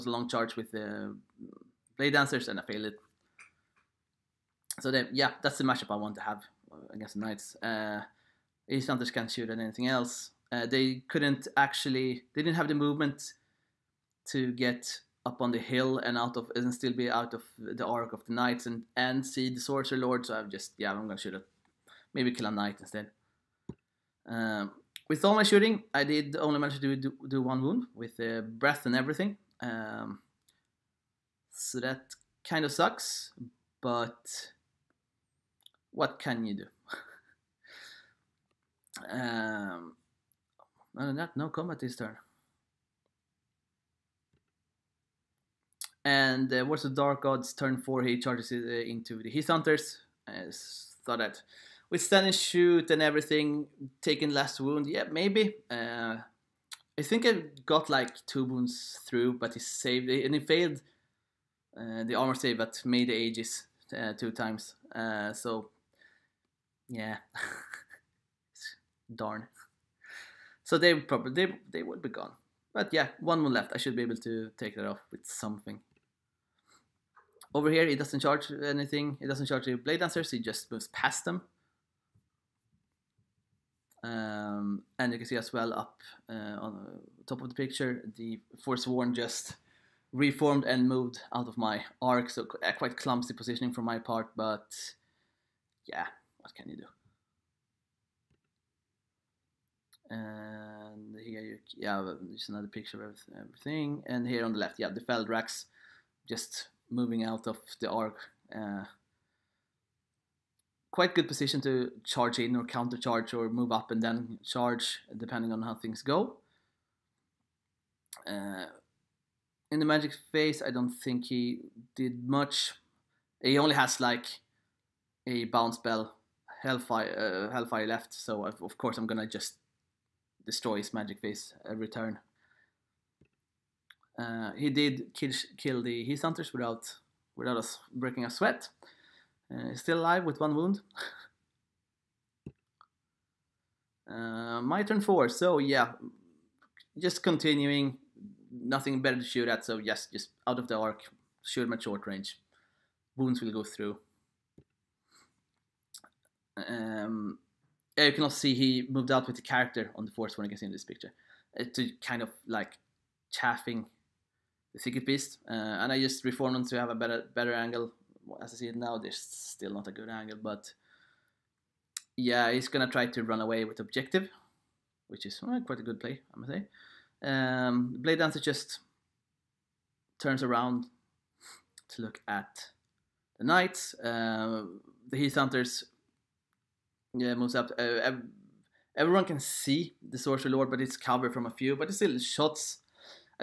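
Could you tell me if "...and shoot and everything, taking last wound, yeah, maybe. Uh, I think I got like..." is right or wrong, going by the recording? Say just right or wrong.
right.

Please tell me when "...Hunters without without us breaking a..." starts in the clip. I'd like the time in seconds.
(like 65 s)
136 s.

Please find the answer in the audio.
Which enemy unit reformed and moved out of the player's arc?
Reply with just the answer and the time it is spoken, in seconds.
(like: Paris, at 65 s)
The Forsworn, at 88 s.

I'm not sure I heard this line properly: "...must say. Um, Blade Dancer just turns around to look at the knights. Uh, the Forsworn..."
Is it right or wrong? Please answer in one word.
wrong.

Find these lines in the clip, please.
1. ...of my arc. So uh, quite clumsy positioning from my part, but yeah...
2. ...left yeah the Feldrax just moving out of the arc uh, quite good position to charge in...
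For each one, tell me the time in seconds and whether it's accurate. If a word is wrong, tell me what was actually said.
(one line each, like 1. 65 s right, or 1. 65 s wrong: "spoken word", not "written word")
1. 91 s right
2. 104 s right.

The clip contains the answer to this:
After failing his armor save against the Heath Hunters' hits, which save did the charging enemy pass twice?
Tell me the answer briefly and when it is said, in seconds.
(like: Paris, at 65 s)
Aegis, at 63 s.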